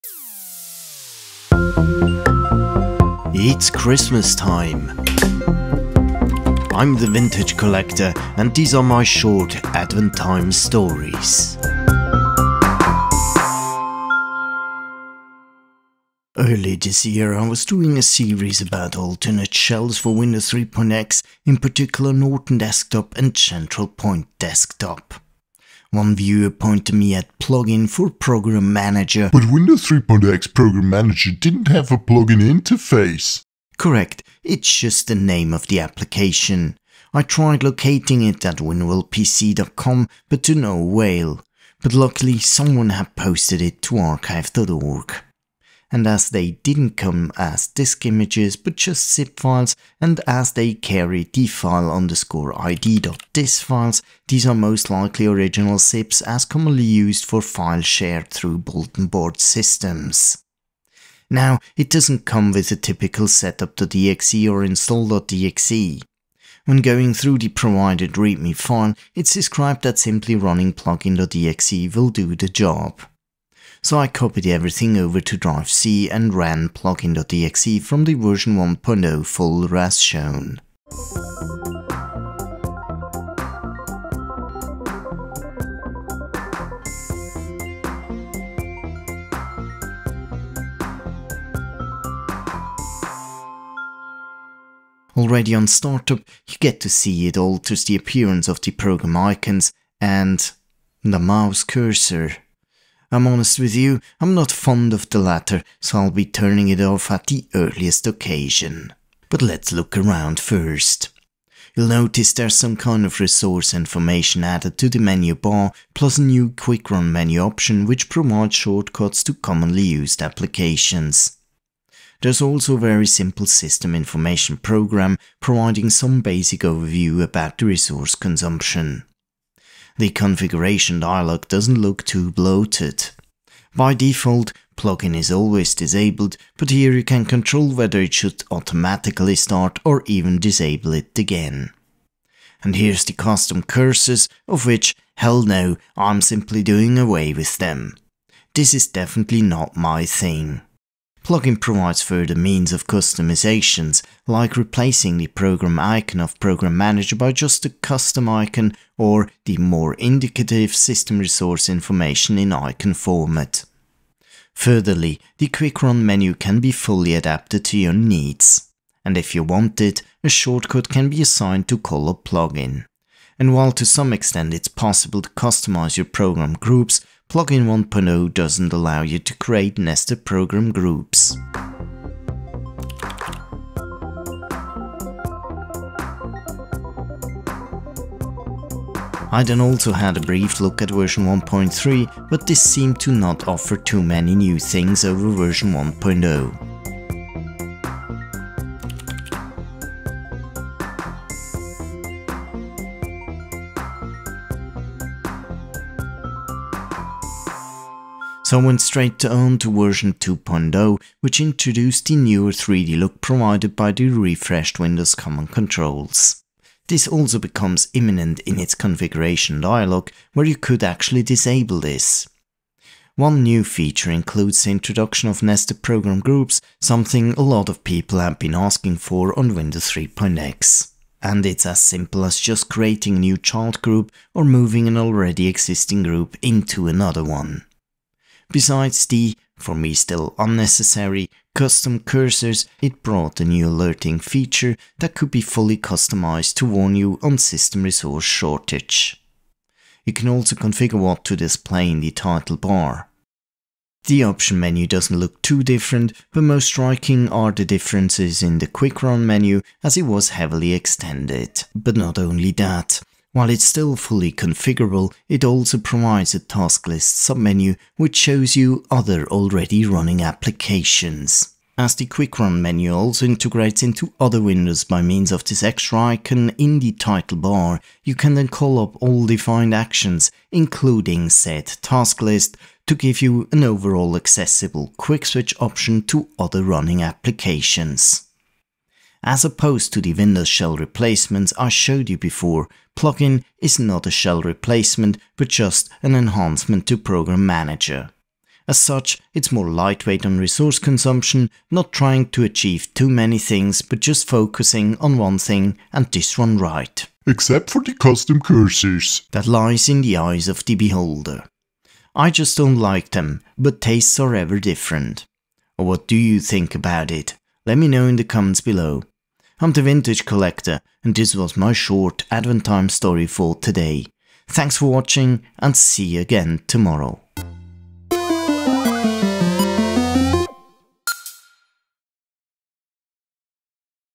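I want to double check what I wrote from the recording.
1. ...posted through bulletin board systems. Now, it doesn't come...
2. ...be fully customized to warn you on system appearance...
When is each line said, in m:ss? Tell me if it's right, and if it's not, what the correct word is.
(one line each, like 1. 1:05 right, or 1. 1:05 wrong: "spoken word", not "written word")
1. 0:57 wrong: "shared", not "posted"
2. 4:05 wrong: "resource", not "appearance".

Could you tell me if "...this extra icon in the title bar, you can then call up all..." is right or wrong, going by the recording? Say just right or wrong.
right.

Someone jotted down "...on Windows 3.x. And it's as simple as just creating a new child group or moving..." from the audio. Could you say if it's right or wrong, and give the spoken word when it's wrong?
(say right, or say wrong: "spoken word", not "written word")
right.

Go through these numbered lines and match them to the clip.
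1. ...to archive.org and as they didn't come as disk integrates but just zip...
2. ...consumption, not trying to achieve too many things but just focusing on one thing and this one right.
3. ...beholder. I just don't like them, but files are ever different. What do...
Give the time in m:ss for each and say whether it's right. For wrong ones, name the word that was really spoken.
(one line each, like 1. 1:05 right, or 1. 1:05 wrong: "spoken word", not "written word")
1. 0:43 wrong: "images", not "integrates"
2. 5:00 right
3. 5:10 wrong: "tastes", not "files".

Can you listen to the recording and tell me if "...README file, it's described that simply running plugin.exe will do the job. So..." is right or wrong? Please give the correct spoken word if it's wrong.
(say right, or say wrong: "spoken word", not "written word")
right.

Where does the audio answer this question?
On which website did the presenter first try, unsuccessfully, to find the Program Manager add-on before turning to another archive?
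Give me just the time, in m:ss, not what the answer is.
0:38.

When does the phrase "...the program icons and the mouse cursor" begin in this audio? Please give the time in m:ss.
1:38.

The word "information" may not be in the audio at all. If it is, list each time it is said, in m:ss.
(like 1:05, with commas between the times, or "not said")
1:53, 2:03, 2:41.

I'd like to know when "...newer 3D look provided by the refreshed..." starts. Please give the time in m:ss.
3:32.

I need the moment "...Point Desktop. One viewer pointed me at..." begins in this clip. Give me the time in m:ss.
0:23.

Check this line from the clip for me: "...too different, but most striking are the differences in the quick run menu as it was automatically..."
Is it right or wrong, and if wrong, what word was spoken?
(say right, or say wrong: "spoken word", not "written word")
wrong: "heavily", not "automatically".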